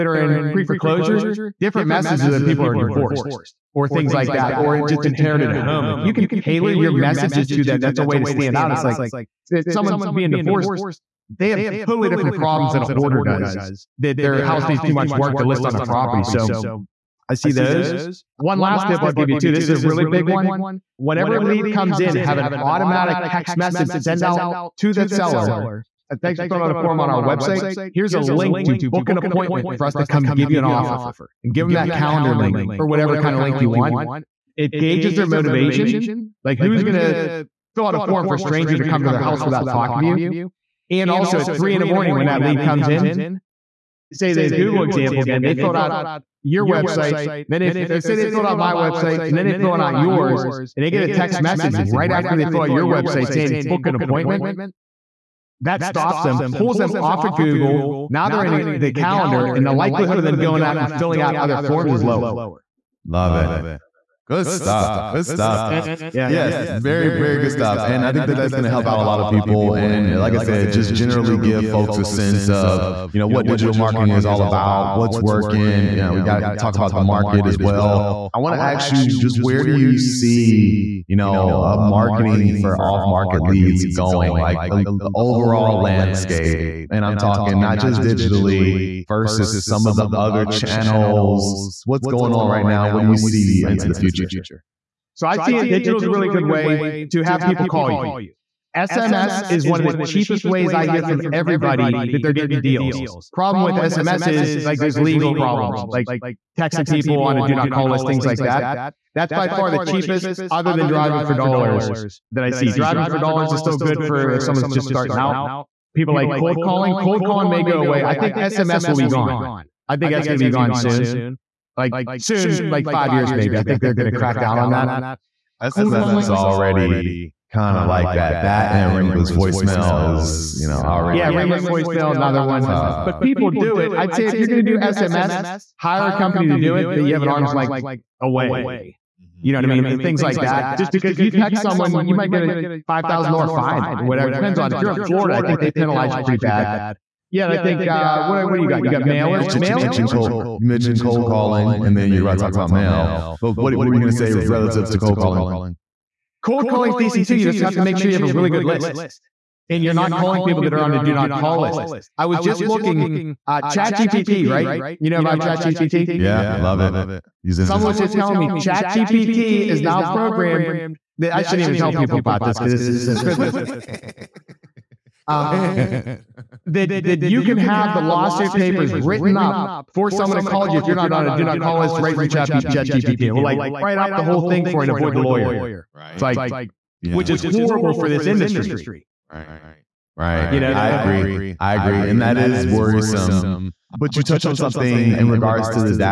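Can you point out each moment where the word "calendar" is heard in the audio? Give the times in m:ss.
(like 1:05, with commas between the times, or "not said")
0:31, 0:58.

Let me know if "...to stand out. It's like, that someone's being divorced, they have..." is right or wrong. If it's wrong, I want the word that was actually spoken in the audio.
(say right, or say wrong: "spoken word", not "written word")
right.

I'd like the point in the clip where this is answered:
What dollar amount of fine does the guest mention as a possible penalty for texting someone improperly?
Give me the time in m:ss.
2:22.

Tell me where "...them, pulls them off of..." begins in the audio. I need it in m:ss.
0:56.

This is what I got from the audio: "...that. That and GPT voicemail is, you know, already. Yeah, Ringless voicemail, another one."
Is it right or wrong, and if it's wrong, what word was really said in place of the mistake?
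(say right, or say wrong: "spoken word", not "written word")
wrong: "Ringless", not "GPT".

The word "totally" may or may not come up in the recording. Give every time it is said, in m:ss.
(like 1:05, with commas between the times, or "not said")
0:11.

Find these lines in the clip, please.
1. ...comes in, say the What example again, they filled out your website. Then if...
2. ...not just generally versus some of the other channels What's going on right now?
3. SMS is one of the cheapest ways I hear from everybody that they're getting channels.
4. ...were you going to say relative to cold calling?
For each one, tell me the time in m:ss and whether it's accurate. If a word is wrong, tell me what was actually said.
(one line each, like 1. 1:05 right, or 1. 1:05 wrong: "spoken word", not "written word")
1. 0:42 wrong: "Google", not "What"
2. 1:27 wrong: "digitally", not "generally"
3. 1:38 wrong: "deals", not "channels"
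4. 2:33 right.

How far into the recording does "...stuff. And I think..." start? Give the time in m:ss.
1:07.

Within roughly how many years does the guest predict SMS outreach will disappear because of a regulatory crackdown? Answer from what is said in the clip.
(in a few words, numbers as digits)
5 years.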